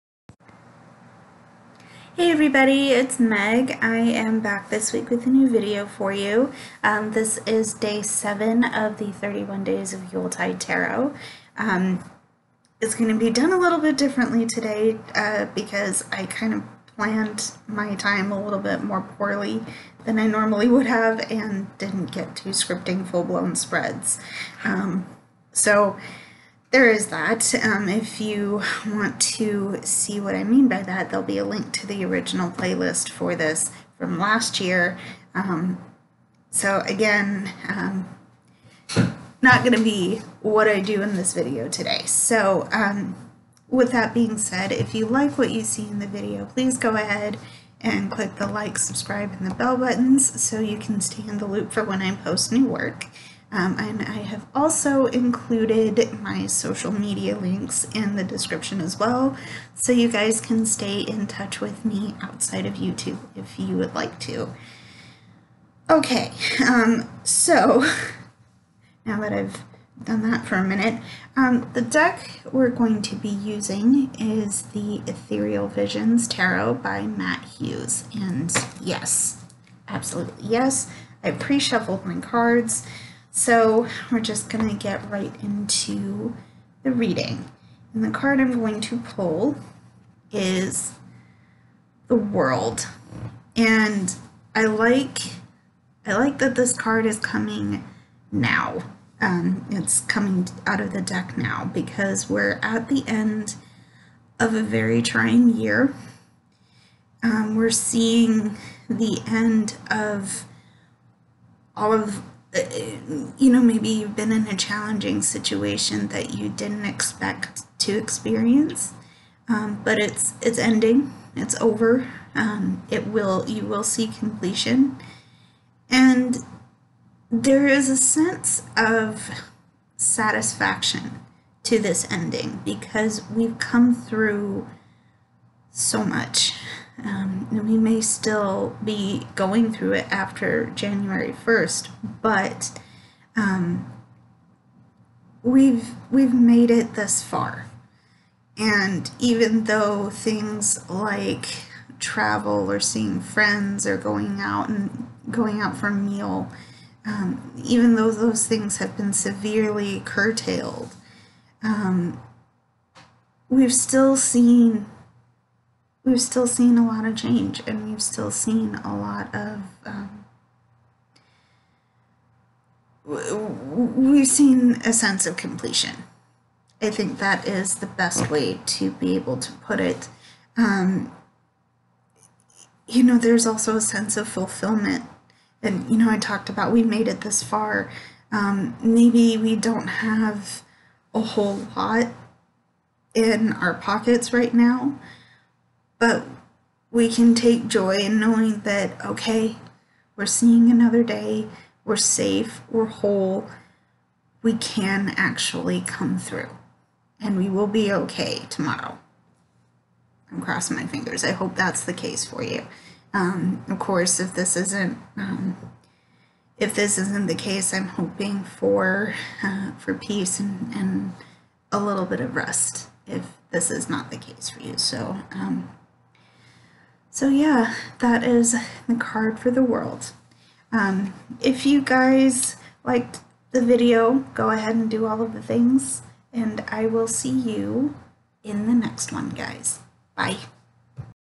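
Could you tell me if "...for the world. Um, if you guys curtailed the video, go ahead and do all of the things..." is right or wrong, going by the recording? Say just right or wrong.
wrong.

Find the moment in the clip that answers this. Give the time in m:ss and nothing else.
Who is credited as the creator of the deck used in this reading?
1:17.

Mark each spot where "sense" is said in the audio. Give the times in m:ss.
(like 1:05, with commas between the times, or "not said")
2:07, 2:54, 3:03.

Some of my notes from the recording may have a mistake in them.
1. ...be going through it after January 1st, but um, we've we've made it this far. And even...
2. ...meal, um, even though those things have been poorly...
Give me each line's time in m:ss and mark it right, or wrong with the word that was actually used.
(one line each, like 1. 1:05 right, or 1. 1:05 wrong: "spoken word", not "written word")
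1. 2:18 right
2. 2:35 wrong: "severely", not "poorly".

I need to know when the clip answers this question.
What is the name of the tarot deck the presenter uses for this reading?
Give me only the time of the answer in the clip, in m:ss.
1:15.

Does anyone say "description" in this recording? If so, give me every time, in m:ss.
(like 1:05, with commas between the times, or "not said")
0:58.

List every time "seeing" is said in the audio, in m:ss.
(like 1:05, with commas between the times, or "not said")
1:47, 2:32, 3:20.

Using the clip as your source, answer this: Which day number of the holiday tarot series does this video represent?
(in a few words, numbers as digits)
7.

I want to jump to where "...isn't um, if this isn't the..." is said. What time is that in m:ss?
3:34.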